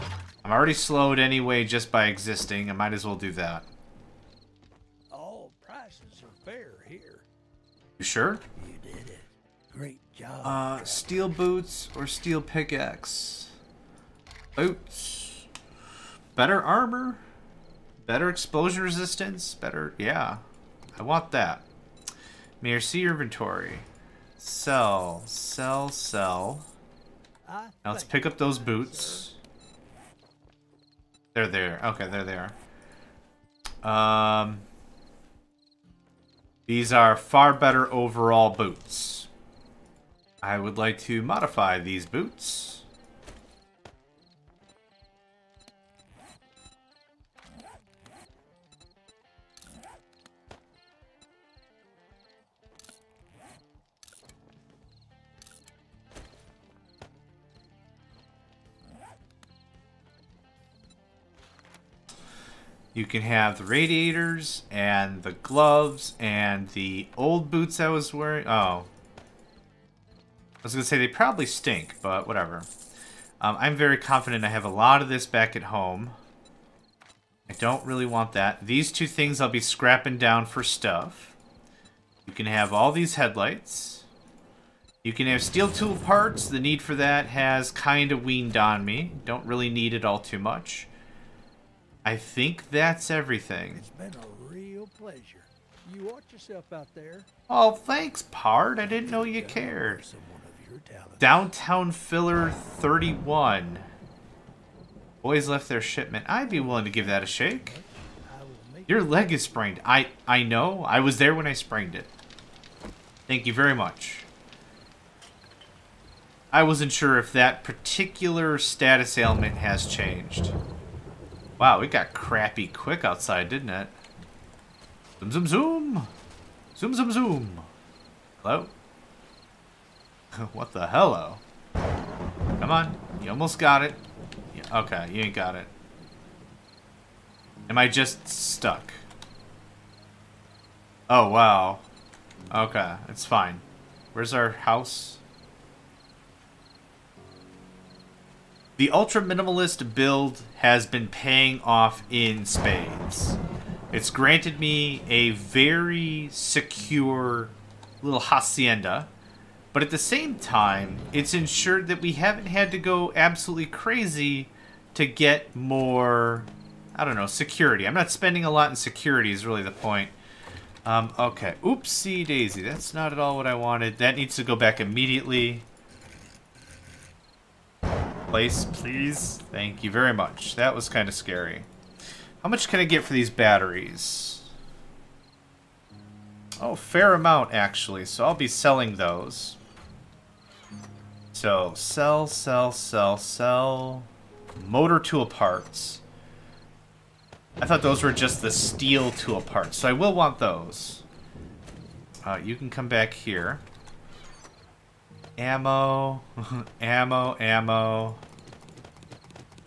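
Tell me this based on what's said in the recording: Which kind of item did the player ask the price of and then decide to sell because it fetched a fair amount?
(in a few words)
Batteries.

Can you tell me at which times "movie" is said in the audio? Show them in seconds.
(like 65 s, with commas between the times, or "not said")
not said.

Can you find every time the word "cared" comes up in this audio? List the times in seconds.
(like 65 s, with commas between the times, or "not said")
99 s.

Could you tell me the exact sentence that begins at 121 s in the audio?
Wow, it got crappy quick outside, didn't it?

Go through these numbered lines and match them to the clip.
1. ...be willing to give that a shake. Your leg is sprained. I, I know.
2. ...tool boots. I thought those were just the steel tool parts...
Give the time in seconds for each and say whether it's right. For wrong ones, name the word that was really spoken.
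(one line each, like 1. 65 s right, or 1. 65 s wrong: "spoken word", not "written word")
1. 106 s right
2. 194 s wrong: "parts", not "boots".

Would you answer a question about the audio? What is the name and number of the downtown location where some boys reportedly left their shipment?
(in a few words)
Downtown Filler 31.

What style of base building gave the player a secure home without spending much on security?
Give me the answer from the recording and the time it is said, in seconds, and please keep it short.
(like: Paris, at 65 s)
Ultra minimalist build, at 148 s.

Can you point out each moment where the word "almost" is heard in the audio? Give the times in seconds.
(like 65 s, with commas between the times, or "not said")
133 s.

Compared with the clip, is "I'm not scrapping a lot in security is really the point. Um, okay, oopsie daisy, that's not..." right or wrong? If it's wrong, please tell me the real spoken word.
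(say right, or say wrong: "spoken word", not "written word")
wrong: "spending", not "scrapping".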